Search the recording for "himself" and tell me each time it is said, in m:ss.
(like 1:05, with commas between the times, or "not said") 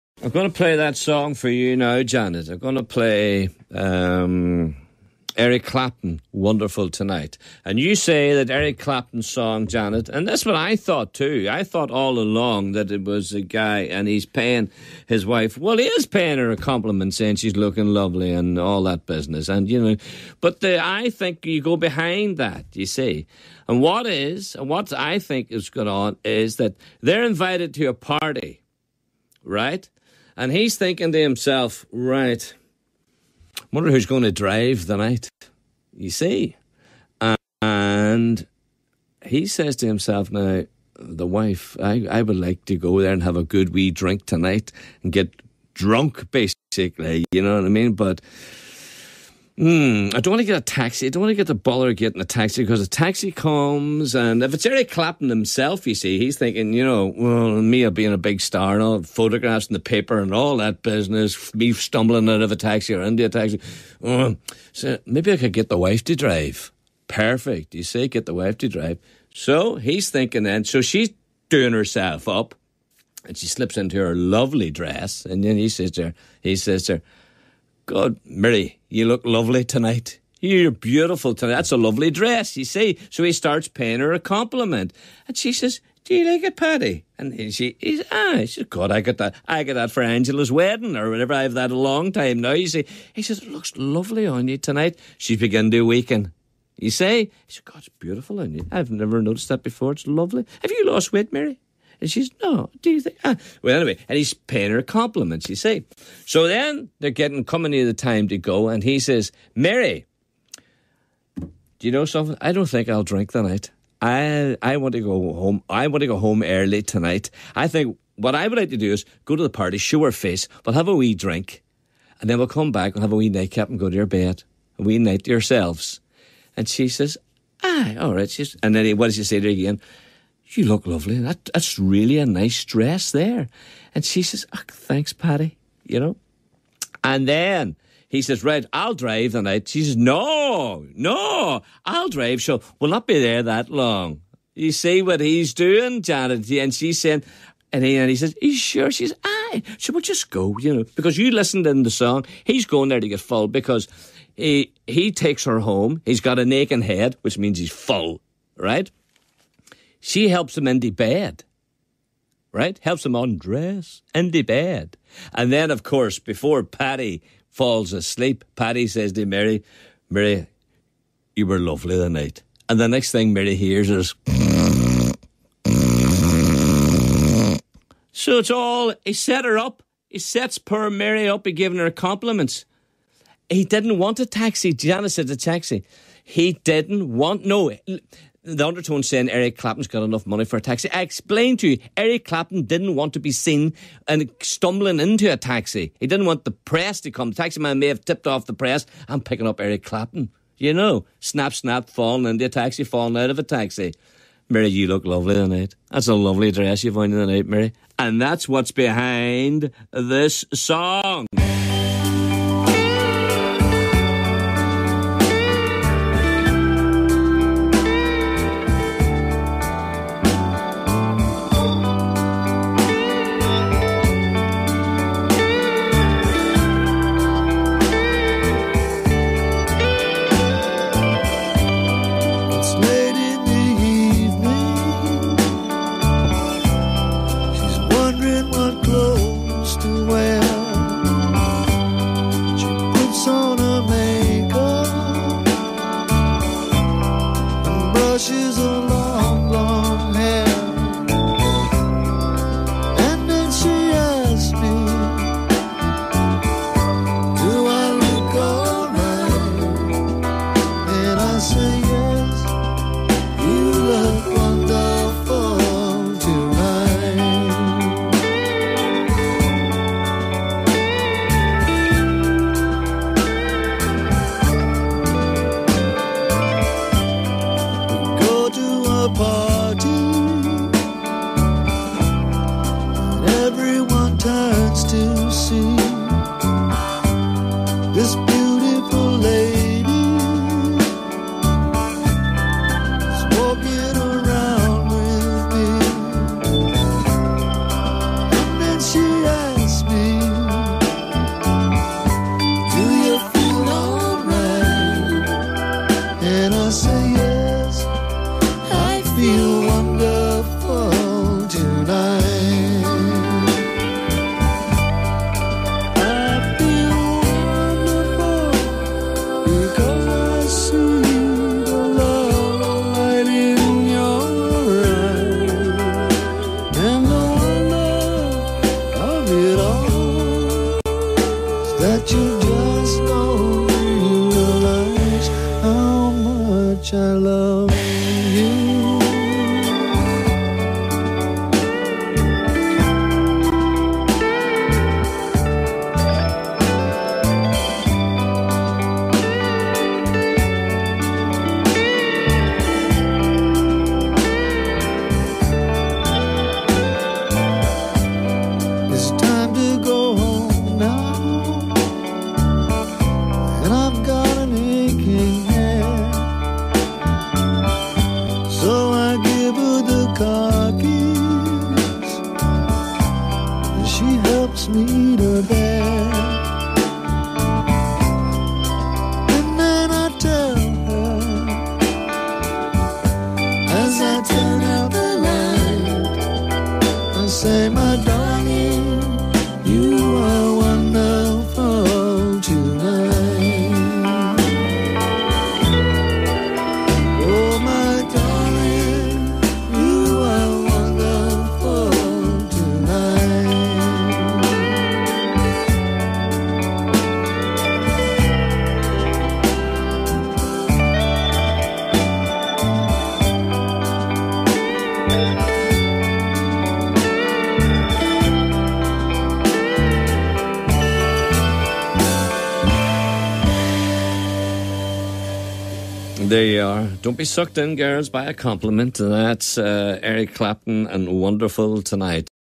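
0:31, 0:39, 0:55.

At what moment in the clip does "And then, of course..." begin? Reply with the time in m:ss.
2:45.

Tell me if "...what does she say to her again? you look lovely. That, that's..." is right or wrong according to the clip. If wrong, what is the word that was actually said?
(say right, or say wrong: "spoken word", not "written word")
right.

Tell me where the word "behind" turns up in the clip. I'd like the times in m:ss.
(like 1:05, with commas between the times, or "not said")
0:21, 3:28.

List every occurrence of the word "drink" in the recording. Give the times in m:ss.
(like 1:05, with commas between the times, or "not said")
0:43, 1:53, 2:01.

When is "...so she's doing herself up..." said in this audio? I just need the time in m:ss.
1:10.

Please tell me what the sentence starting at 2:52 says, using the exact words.
And the next thing Mary hears is.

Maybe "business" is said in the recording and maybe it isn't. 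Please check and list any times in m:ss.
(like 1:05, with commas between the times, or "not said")
0:19, 1:00.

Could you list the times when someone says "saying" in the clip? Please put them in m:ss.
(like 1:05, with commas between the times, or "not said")
0:17, 2:26, 3:09.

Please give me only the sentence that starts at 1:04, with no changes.
Uh, so maybe I could get the wife to drive.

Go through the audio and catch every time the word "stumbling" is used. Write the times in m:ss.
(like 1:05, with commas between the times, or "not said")
1:01, 3:14.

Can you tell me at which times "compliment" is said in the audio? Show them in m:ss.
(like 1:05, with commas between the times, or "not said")
0:16, 1:24, 1:44, 3:01, 7:08.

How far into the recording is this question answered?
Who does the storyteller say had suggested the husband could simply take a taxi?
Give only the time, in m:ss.
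3:04.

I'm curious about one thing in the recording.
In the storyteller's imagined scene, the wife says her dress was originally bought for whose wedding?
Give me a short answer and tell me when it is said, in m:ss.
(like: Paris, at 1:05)
Angela, at 1:30.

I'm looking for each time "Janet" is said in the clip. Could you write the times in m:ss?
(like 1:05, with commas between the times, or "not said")
0:02, 0:09, 2:26.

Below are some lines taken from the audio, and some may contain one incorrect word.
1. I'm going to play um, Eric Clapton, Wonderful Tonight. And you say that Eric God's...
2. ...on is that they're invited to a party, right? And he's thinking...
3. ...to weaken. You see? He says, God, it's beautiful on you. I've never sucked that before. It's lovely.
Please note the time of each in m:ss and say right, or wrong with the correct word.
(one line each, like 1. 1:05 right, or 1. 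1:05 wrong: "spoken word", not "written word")
1. 0:02 wrong: "Clapton", not "God"
2. 0:25 right
3. 1:35 wrong: "noticed", not "sucked".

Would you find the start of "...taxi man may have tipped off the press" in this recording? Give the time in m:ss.
3:17.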